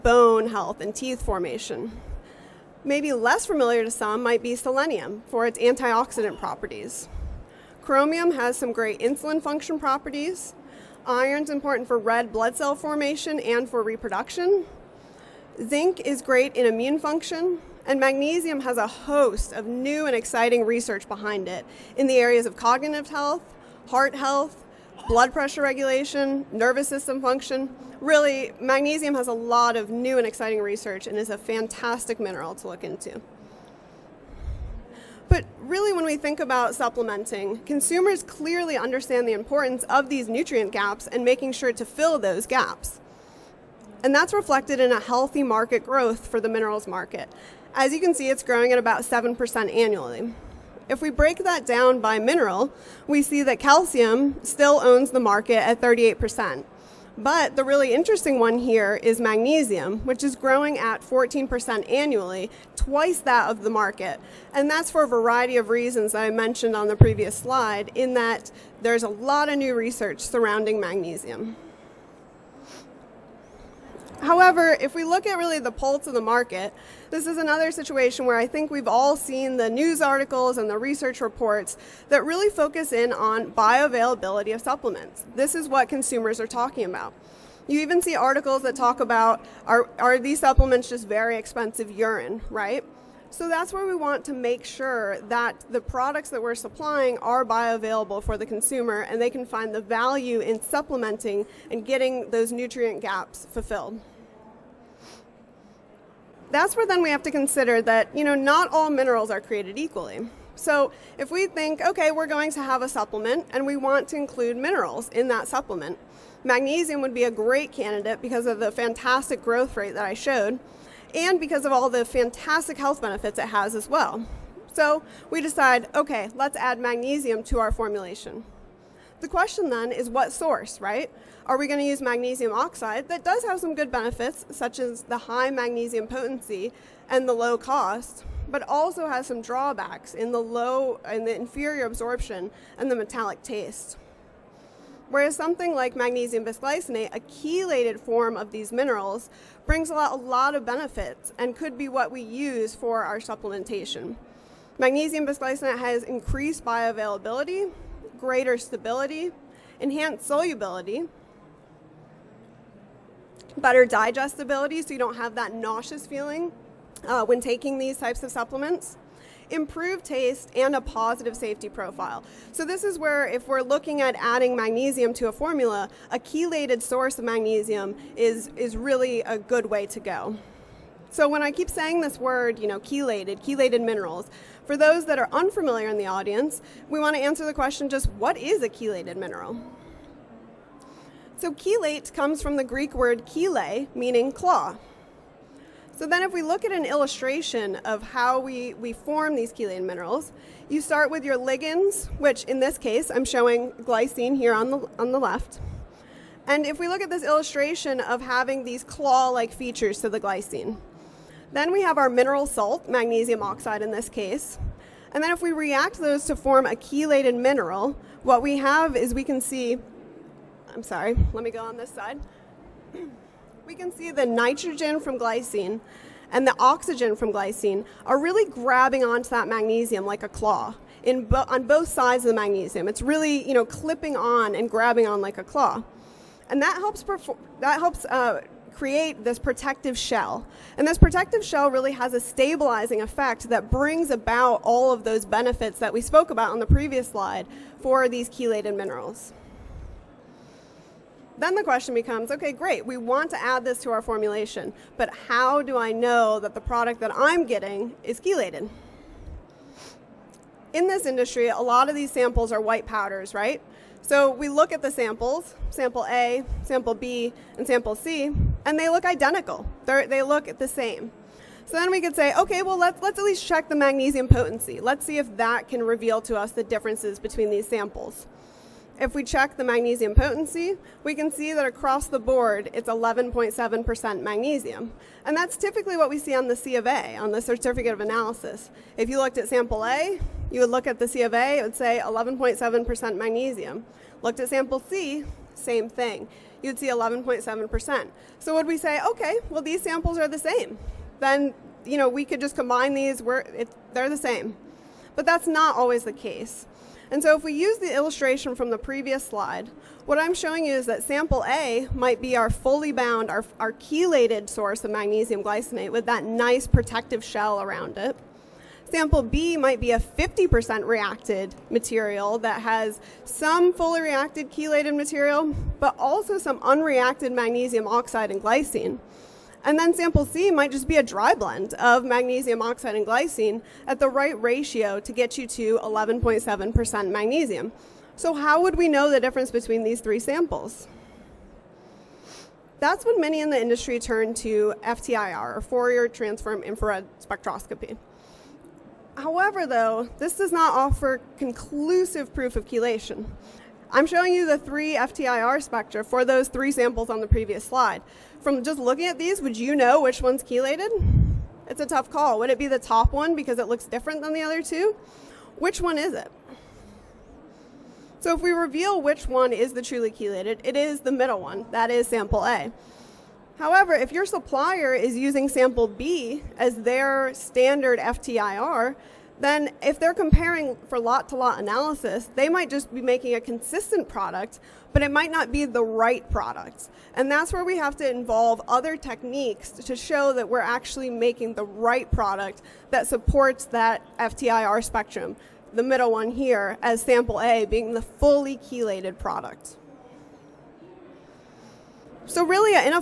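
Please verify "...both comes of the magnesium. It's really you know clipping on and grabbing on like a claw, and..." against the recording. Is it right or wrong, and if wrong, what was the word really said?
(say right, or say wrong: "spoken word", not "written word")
wrong: "sides", not "comes".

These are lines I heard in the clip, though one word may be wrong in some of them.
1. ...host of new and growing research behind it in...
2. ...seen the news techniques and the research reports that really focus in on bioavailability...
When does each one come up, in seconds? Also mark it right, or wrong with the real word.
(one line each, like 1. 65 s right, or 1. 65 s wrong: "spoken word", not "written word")
1. 18 s wrong: "exciting", not "growing"
2. 79 s wrong: "articles", not "techniques".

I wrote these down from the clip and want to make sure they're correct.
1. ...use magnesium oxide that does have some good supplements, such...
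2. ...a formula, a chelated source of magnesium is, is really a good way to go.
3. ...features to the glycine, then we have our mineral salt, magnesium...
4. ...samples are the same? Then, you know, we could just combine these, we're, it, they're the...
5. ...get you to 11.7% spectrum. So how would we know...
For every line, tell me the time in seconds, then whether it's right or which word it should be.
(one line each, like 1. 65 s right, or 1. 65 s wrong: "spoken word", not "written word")
1. 131 s wrong: "benefits", not "supplements"
2. 175 s right
3. 209 s right
4. 299 s right
5. 335 s wrong: "magnesium", not "spectrum".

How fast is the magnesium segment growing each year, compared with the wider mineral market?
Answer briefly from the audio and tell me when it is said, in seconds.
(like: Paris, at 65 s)
14%, at 61 s.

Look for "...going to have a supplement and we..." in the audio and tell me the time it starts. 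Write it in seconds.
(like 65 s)
112 s.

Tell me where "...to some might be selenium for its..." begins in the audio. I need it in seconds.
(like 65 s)
3 s.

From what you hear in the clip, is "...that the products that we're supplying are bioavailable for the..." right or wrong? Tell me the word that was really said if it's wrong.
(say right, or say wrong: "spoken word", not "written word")
right.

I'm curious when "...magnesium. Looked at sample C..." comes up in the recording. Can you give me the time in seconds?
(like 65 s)
293 s.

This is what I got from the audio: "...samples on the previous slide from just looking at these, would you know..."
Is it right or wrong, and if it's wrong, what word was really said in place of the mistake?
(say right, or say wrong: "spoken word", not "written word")
right.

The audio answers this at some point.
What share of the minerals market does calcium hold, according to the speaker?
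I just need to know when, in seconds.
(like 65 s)
55 s.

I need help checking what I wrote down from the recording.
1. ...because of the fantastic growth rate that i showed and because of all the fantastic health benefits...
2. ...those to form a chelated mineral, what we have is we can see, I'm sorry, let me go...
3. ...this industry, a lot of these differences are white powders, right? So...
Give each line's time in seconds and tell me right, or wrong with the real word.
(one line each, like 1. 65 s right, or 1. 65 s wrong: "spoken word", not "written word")
1. 118 s right
2. 215 s right
3. 260 s wrong: "samples", not "differences".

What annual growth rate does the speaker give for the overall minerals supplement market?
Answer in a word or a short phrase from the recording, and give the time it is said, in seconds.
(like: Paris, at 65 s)
7%, at 48 s.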